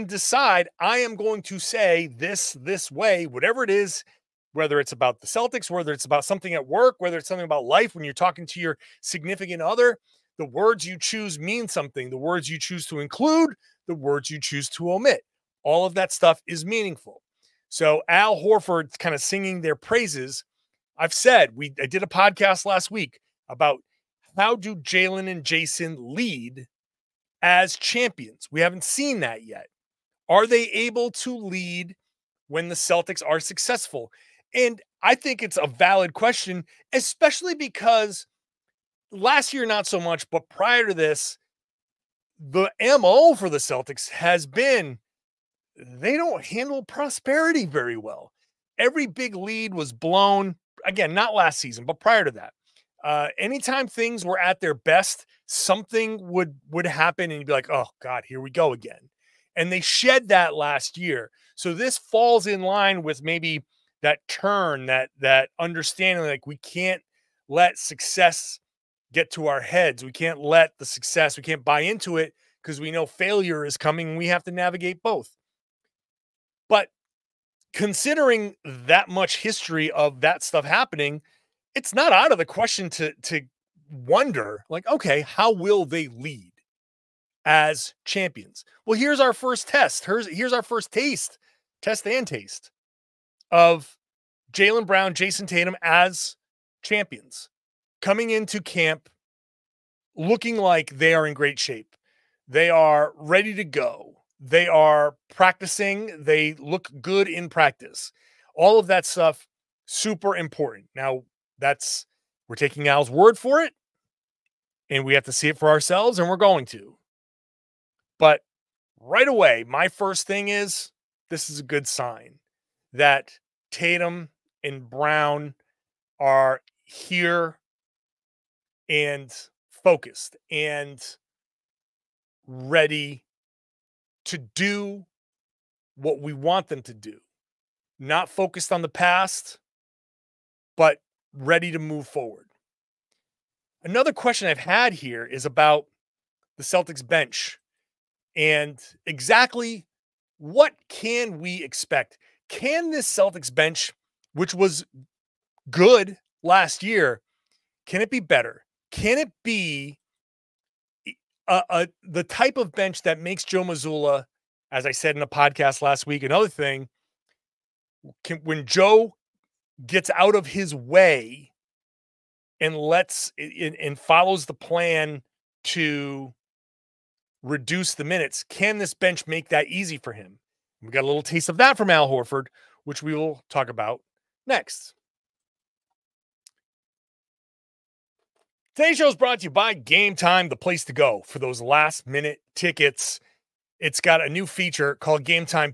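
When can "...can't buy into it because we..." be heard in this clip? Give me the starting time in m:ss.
1:11.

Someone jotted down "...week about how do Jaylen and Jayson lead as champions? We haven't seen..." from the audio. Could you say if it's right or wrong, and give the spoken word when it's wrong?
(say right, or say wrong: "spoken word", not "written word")
right.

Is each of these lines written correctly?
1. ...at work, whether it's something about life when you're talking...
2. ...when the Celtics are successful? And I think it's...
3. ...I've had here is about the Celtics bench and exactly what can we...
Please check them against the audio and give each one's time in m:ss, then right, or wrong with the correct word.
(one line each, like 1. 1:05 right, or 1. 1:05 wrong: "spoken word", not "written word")
1. 0:06 right
2. 0:32 right
3. 2:24 right.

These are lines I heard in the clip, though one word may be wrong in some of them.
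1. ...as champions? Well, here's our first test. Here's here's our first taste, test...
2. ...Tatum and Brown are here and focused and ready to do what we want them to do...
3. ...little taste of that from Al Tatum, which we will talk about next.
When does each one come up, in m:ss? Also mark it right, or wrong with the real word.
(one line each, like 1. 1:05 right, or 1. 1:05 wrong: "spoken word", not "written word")
1. 1:27 right
2. 2:03 right
3. 3:01 wrong: "Horford", not "Tatum".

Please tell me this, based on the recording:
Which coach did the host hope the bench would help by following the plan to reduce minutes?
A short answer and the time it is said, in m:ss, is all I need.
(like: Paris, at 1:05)
Joe Mazzulla, at 2:43.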